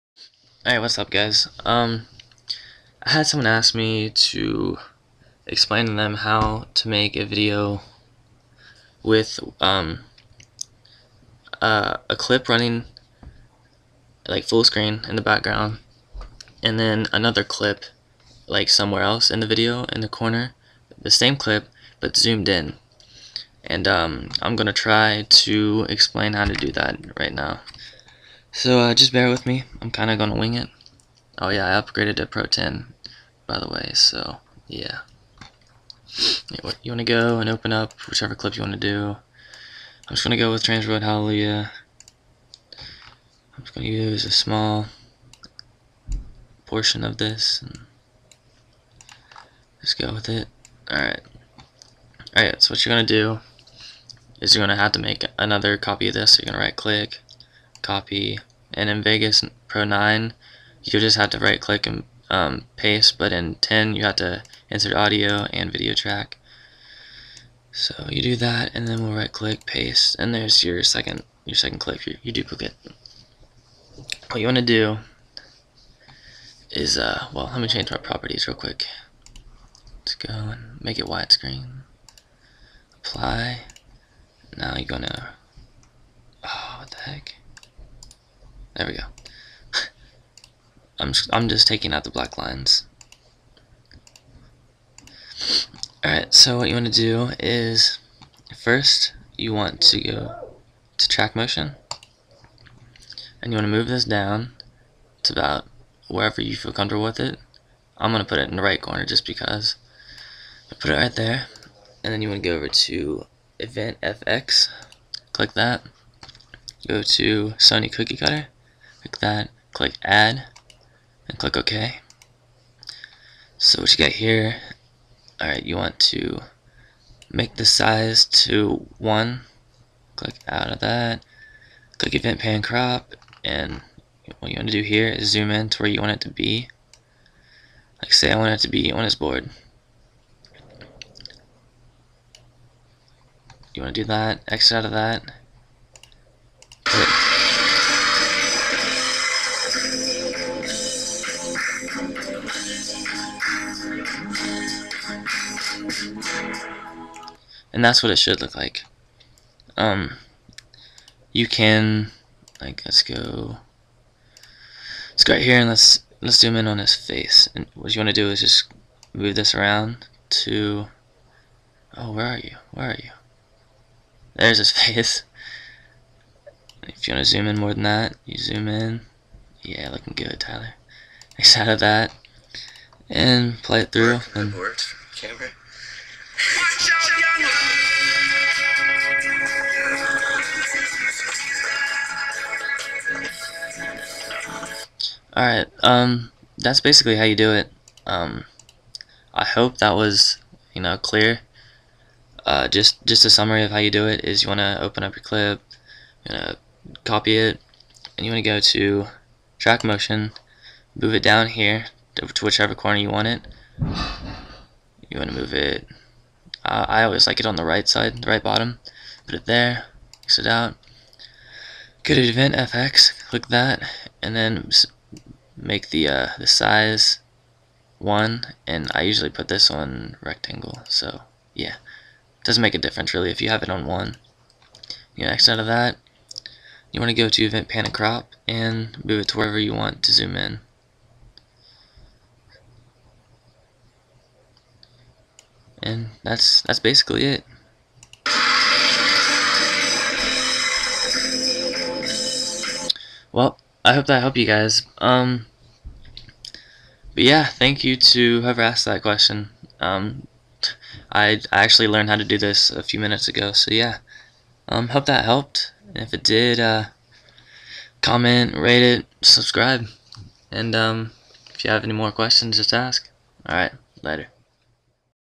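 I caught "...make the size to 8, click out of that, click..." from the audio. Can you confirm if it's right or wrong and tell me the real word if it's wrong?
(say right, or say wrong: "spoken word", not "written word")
wrong: "1", not "8".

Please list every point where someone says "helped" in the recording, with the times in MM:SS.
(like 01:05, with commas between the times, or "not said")
04:14, 04:25.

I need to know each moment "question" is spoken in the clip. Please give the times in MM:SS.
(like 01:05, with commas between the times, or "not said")
04:19, 04:32.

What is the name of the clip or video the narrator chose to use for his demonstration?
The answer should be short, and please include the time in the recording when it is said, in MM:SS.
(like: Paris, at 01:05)
Transworld Hallelujah, at 00:40.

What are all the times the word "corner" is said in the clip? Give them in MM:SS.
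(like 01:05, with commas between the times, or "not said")
00:20, 01:48, 03:32.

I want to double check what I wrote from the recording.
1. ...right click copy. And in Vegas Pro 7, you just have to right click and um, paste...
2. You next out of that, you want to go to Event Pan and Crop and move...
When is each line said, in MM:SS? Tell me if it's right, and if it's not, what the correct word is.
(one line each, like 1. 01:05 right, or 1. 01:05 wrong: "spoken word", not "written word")
1. 00:56 wrong: "9", not "7"
2. 03:55 right.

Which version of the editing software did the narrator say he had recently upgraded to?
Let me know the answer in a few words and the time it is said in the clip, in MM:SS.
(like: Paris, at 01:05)
Pro 10, at 00:32.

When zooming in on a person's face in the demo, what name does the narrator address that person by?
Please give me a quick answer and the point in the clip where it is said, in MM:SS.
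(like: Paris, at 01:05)
Tyler, at 03:00.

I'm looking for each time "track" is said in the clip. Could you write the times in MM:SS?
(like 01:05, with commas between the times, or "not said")
01:05, 01:41, 03:29.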